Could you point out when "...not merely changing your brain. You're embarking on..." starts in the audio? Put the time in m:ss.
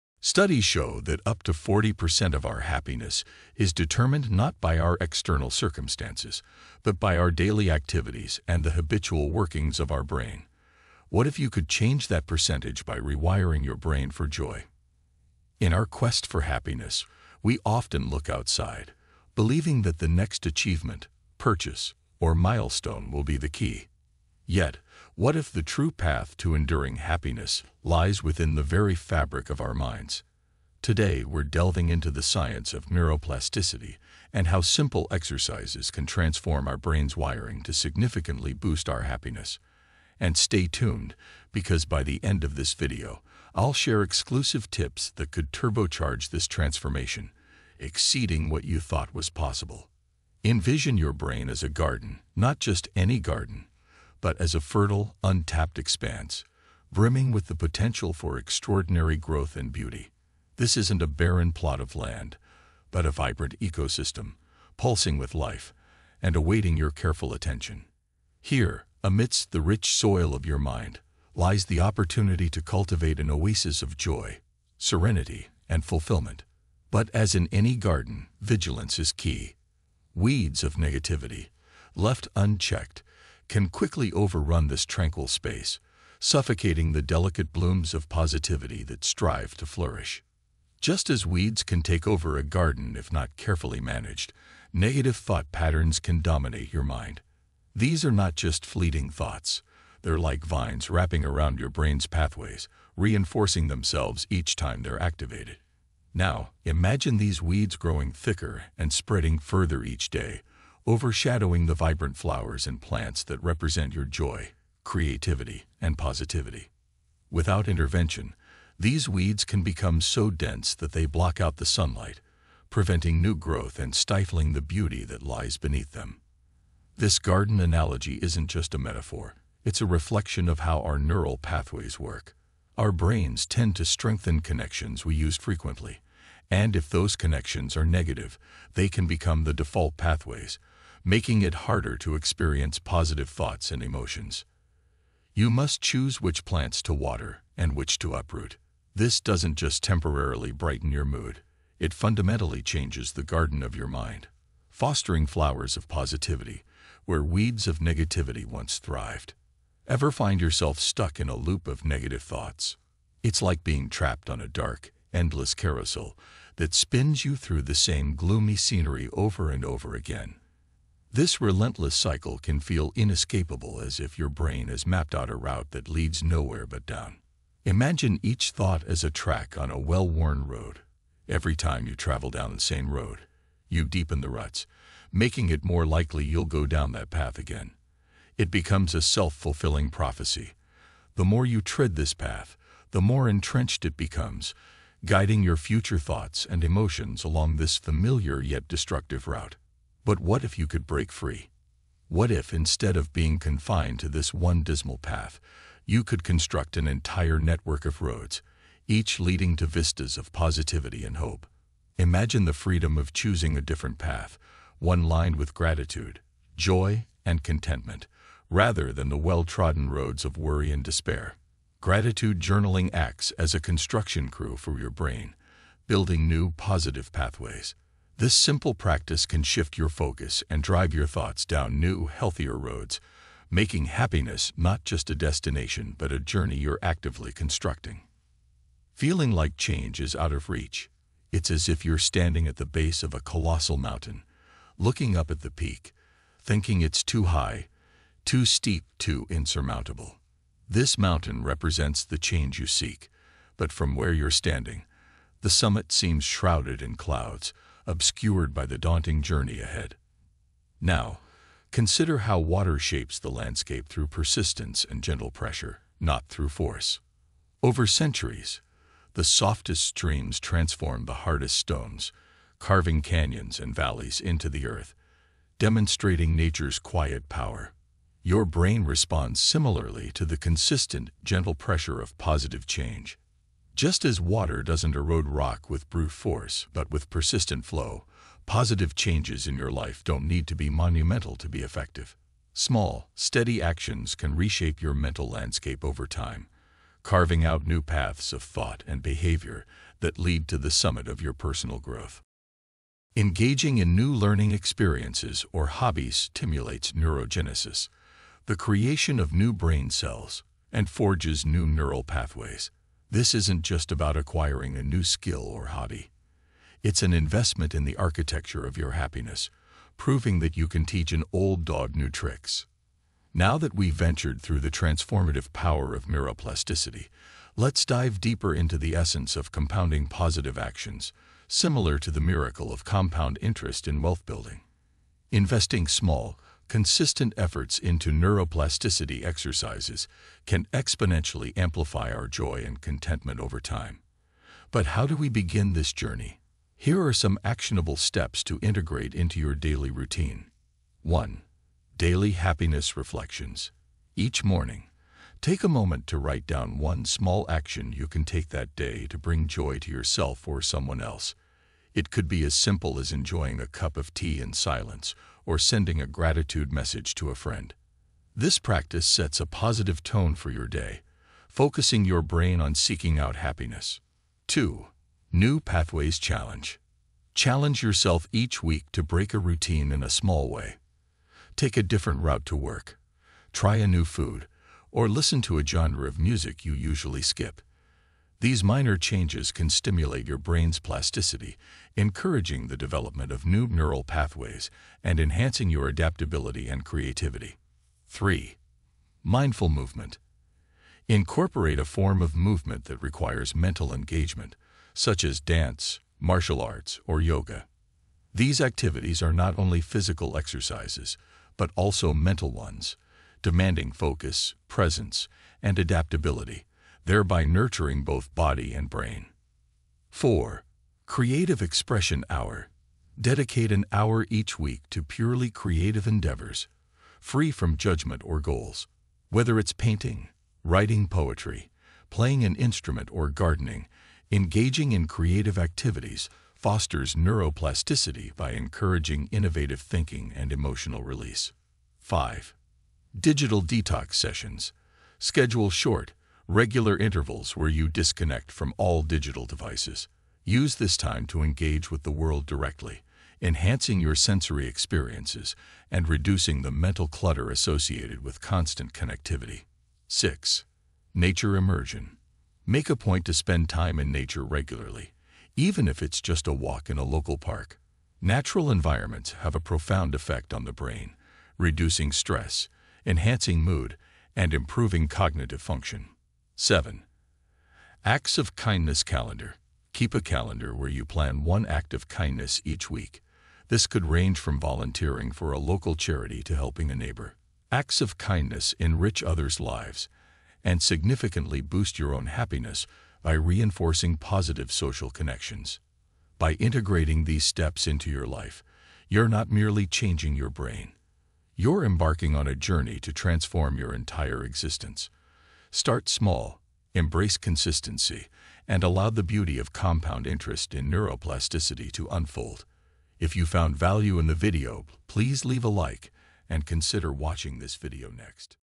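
8:19.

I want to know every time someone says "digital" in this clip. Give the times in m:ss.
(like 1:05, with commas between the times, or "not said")
7:23, 7:29.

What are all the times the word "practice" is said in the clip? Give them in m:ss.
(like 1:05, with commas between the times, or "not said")
3:48, 6:08.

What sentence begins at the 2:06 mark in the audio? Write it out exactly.
This garden analogy isn't just a metaphor, it's a reflection of how our neural pathways work.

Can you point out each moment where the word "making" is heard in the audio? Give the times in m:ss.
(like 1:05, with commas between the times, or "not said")
2:21, 3:05, 3:53.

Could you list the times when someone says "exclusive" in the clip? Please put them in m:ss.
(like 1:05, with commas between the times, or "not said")
0:44.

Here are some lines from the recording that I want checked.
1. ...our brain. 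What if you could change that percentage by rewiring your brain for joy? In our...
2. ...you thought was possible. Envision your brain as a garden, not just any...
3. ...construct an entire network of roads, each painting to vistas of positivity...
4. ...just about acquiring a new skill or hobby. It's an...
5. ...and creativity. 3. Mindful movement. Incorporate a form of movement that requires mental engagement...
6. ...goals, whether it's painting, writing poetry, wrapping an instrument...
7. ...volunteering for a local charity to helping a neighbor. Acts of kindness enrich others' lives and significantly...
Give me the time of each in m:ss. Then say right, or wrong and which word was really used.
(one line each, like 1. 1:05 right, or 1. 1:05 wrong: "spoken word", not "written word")
1. 0:09 right
2. 0:48 right
3. 3:26 wrong: "leading", not "painting"
4. 5:13 right
5. 6:36 right
6. 7:08 wrong: "playing", not "wrapping"
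7. 8:04 right.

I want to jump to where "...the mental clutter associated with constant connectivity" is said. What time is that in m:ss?
7:36.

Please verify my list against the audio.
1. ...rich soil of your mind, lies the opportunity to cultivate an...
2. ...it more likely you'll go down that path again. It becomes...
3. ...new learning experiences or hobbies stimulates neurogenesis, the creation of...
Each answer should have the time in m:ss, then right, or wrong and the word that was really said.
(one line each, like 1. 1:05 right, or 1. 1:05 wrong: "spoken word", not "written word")
1. 1:09 right
2. 3:05 right
3. 5:03 right.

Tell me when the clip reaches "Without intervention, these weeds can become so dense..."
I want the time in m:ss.
1:57.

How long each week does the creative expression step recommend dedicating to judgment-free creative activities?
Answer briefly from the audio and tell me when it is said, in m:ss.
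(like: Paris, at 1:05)
An hour, at 7:03.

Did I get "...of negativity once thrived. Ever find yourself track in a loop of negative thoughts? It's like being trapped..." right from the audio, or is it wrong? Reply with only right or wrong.
wrong.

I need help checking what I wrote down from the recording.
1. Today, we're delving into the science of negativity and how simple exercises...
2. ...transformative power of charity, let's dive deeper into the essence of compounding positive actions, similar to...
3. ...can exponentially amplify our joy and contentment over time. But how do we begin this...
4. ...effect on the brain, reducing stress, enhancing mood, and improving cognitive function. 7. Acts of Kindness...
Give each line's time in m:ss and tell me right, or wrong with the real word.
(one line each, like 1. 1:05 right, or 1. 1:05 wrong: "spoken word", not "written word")
1. 0:30 wrong: "neuroplasticity", not "negativity"
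2. 5:24 wrong: "neuroplasticity", not "charity"
3. 5:40 right
4. 7:50 right.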